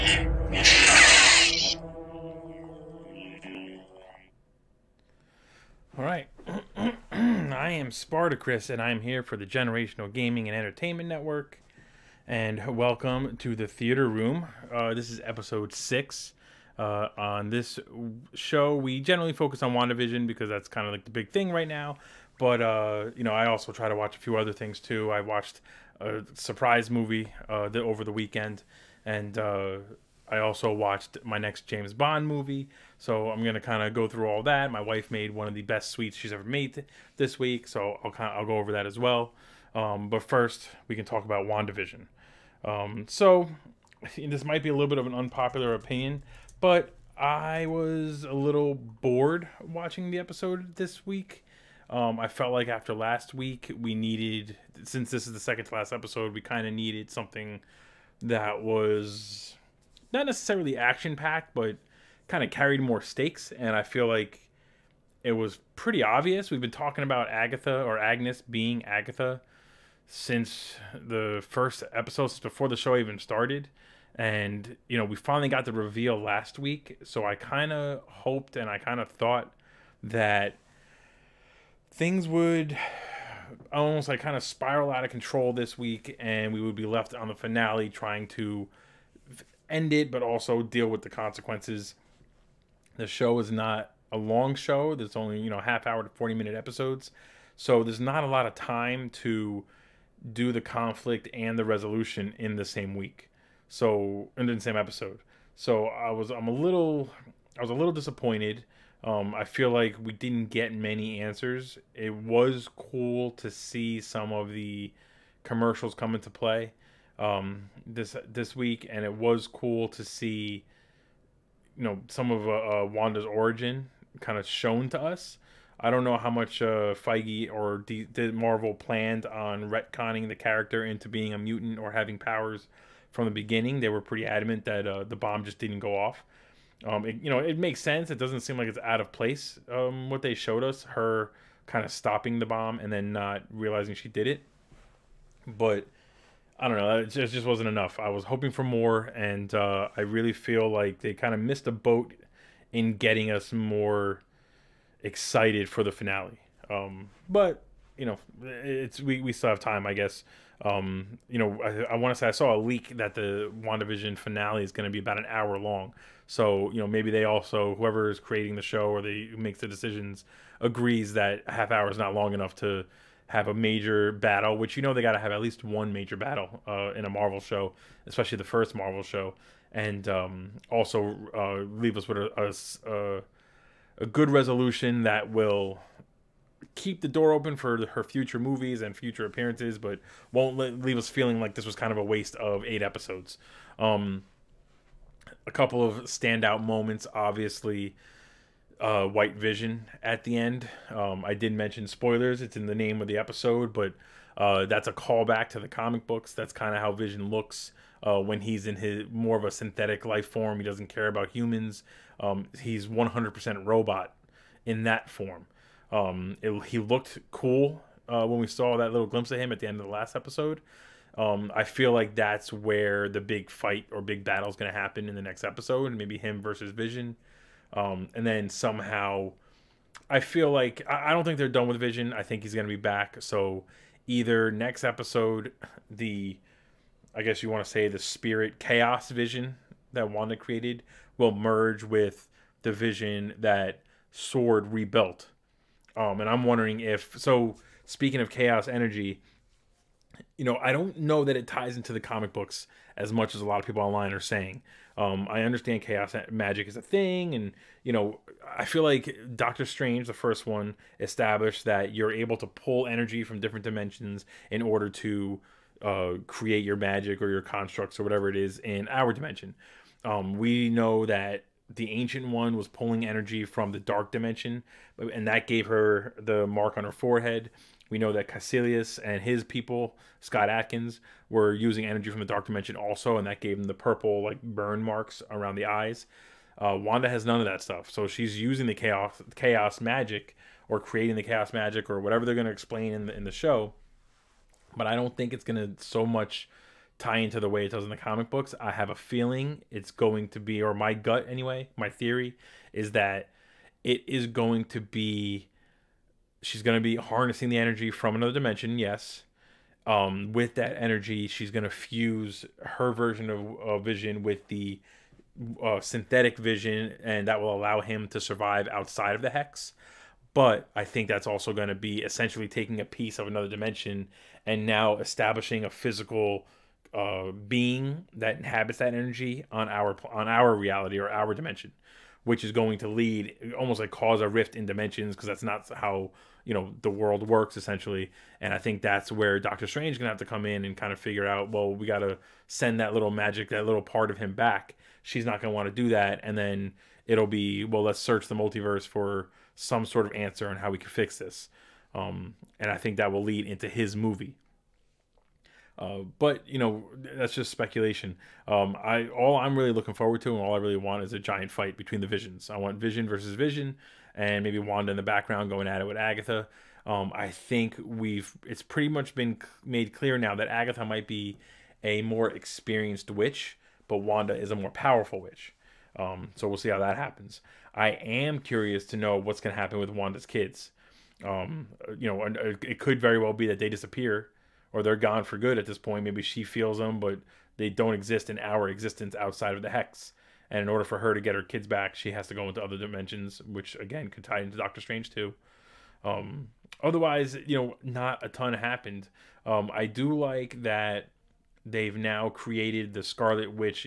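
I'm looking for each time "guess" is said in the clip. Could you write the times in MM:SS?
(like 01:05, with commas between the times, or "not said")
02:39, 03:57.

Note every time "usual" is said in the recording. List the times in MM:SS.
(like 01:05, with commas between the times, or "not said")
not said.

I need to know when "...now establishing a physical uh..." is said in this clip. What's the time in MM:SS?
05:24.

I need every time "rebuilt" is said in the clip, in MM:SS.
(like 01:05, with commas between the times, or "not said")
04:04.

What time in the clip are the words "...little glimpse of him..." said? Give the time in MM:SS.
03:38.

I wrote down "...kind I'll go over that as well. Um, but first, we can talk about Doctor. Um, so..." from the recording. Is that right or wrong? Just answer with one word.
wrong.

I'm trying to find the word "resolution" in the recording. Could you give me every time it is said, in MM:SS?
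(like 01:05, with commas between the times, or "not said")
01:41, 03:04.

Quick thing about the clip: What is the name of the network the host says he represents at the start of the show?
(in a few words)
Generational Gaming and Entertainment Network.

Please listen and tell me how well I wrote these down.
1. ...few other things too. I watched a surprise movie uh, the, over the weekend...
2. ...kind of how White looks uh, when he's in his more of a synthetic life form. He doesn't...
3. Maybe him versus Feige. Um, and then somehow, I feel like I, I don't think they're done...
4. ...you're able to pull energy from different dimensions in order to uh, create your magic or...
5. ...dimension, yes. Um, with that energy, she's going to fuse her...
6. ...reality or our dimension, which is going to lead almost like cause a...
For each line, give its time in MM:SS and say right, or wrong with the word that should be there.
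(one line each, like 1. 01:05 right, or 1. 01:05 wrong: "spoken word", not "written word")
1. 00:24 right
2. 03:26 wrong: "Vision", not "White"
3. 03:45 wrong: "Vision", not "Feige"
4. 04:21 right
5. 05:08 right
6. 05:30 right.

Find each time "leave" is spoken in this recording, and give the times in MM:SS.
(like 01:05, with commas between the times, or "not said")
03:01, 03:10.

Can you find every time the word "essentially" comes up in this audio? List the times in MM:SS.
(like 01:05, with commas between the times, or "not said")
05:22, 05:37.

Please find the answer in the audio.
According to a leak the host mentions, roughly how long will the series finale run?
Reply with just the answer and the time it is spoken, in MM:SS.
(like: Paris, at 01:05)
an hour, at 02:44.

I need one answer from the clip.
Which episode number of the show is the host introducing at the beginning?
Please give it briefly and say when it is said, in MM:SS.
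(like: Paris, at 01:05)
6, at 00:15.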